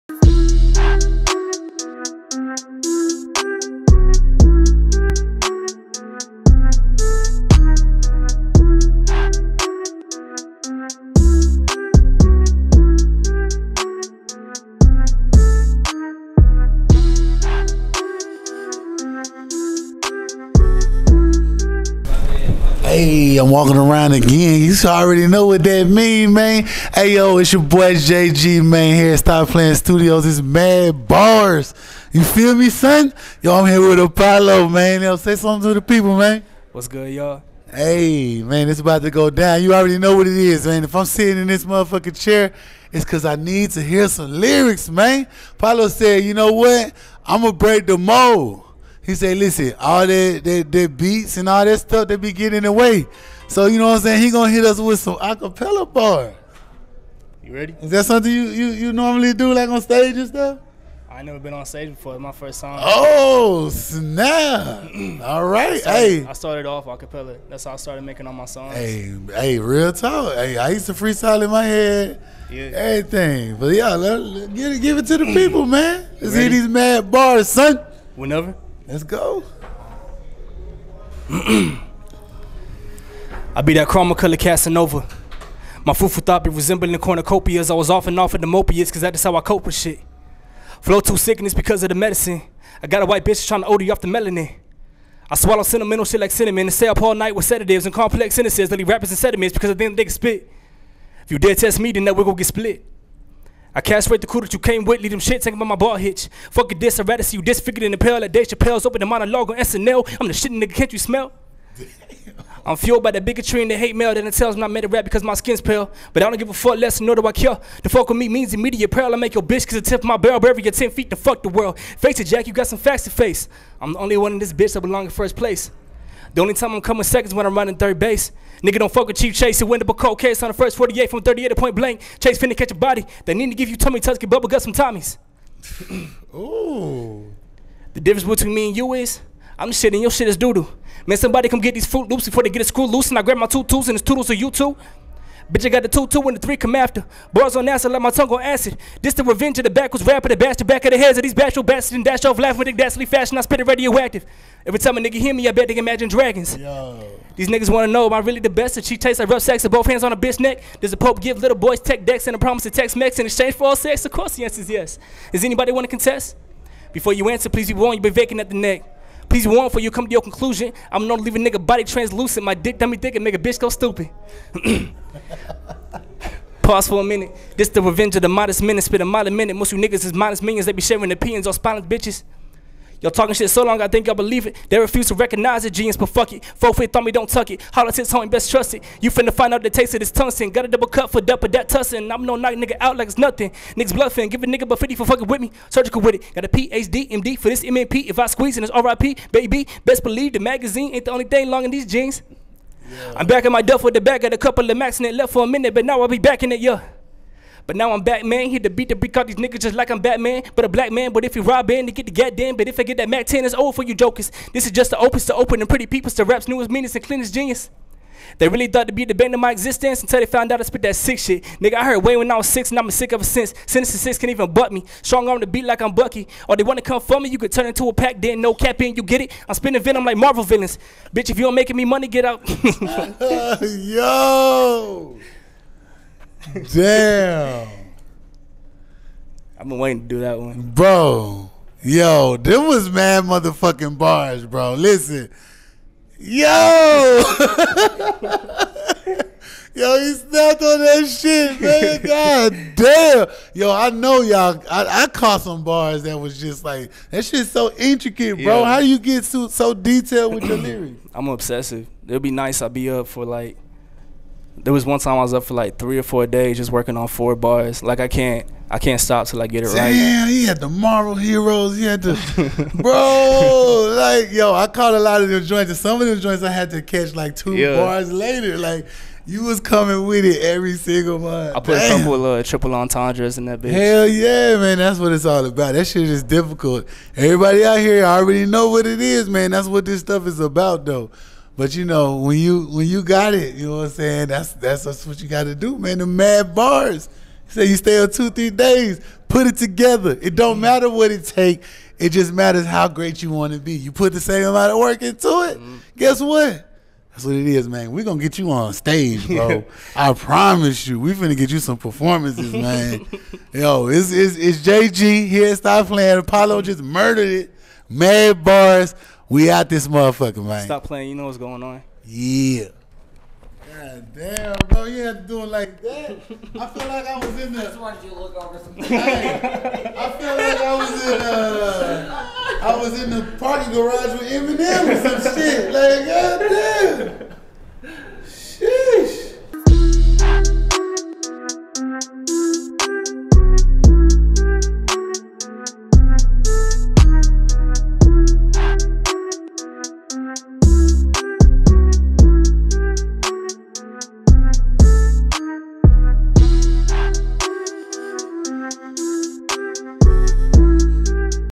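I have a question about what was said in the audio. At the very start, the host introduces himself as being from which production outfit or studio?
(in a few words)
Stop Playing Studios.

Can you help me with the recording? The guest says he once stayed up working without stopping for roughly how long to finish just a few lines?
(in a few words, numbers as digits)
3 or 4 days.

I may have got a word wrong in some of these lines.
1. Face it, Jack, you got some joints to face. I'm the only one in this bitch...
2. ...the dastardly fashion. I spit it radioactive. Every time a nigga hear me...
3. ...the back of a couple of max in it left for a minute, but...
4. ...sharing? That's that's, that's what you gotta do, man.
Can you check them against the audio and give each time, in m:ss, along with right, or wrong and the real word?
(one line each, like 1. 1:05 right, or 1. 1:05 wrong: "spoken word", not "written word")
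1. 2:01 wrong: "facts", not "joints"
2. 2:32 right
3. 3:23 right
4. 4:53 wrong: "saying", not "sharing".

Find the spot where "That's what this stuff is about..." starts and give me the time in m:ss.
4:49.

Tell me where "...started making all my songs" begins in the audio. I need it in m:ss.
1:07.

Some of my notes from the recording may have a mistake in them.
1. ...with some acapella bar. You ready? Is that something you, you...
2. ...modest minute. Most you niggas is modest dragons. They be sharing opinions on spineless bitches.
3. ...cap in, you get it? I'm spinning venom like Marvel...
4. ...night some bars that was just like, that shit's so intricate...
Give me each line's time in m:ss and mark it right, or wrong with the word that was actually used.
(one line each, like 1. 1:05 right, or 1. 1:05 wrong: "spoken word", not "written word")
1. 0:54 right
2. 2:59 wrong: "minions", not "dragons"
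3. 3:48 right
4. 4:15 wrong: "caught", not "night".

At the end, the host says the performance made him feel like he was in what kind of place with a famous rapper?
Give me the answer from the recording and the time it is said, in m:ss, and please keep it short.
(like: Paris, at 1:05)
parking garage, at 5:33.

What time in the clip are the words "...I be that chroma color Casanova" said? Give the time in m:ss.
1:21.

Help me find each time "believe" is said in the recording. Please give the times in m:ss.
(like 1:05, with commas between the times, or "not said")
3:04, 3:20.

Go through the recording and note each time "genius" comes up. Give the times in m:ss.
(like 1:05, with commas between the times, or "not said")
3:05, 3:37.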